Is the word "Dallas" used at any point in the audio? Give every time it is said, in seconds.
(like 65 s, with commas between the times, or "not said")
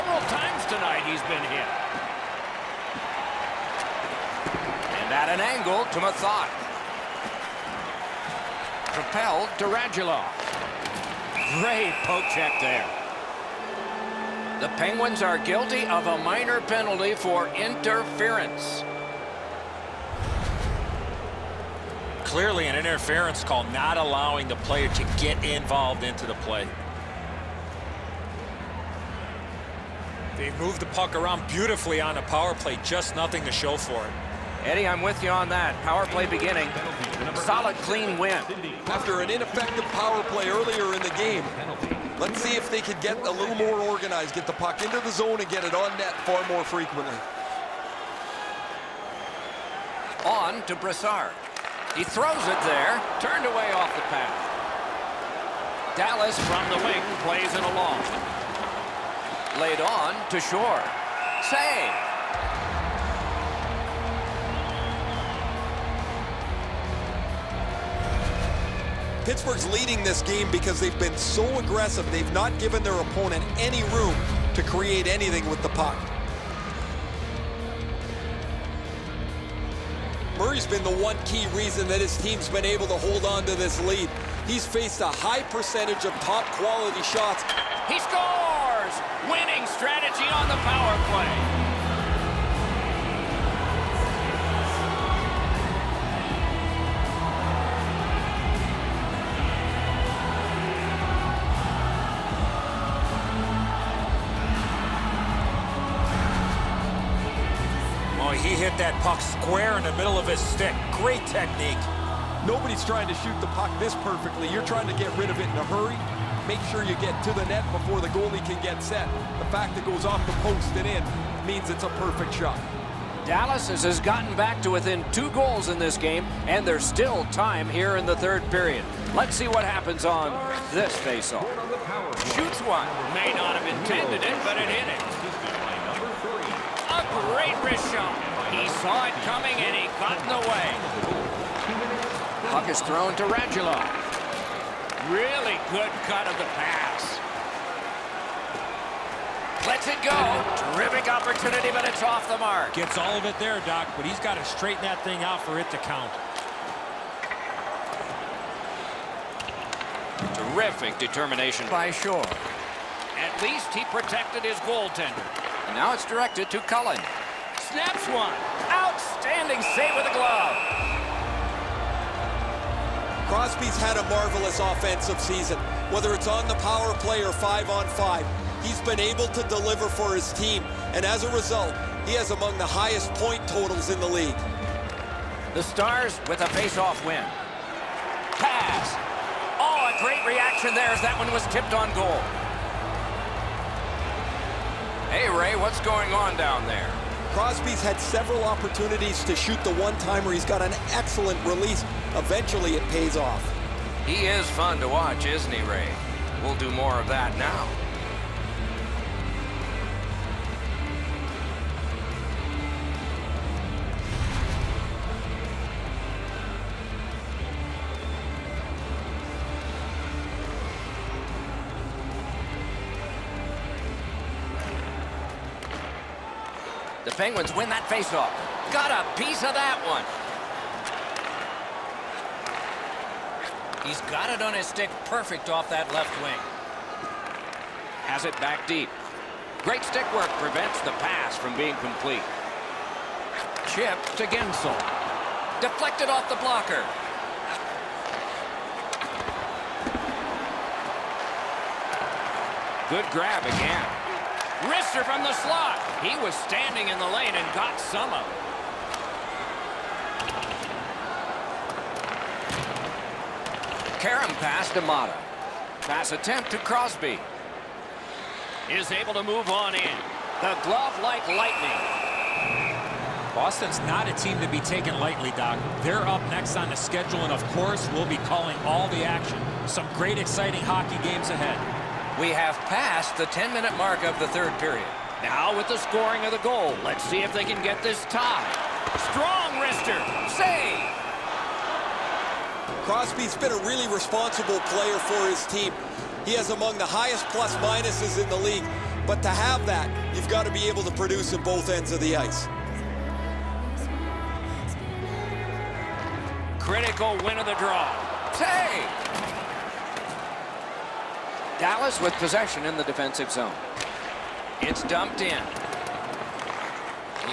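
55 s, 123 s, 311 s.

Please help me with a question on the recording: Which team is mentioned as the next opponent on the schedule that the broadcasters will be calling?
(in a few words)
Boston.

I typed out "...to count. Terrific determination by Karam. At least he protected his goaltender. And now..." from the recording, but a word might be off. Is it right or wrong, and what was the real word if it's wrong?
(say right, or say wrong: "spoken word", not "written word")
wrong: "Shore", not "Karam".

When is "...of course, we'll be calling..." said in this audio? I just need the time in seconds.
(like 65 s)
277 s.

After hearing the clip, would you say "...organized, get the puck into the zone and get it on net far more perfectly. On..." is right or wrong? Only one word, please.
wrong.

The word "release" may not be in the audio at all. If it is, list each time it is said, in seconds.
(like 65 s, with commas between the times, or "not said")
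201 s.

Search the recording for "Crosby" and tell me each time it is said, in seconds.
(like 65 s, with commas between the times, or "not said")
173 s, 197 s, 266 s, 292 s.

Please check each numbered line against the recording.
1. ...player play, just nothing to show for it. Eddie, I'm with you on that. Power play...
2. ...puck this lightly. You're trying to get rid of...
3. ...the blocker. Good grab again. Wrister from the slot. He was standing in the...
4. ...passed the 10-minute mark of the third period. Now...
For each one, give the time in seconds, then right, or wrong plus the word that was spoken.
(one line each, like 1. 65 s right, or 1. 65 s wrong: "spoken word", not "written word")
1. 32 s wrong: "power", not "player"
2. 113 s wrong: "perfectly", not "lightly"
3. 246 s right
4. 282 s right.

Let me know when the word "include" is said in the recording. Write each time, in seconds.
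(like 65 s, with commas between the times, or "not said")
not said.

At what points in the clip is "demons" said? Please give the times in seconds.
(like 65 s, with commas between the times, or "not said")
not said.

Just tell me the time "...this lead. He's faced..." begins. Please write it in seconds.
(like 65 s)
83 s.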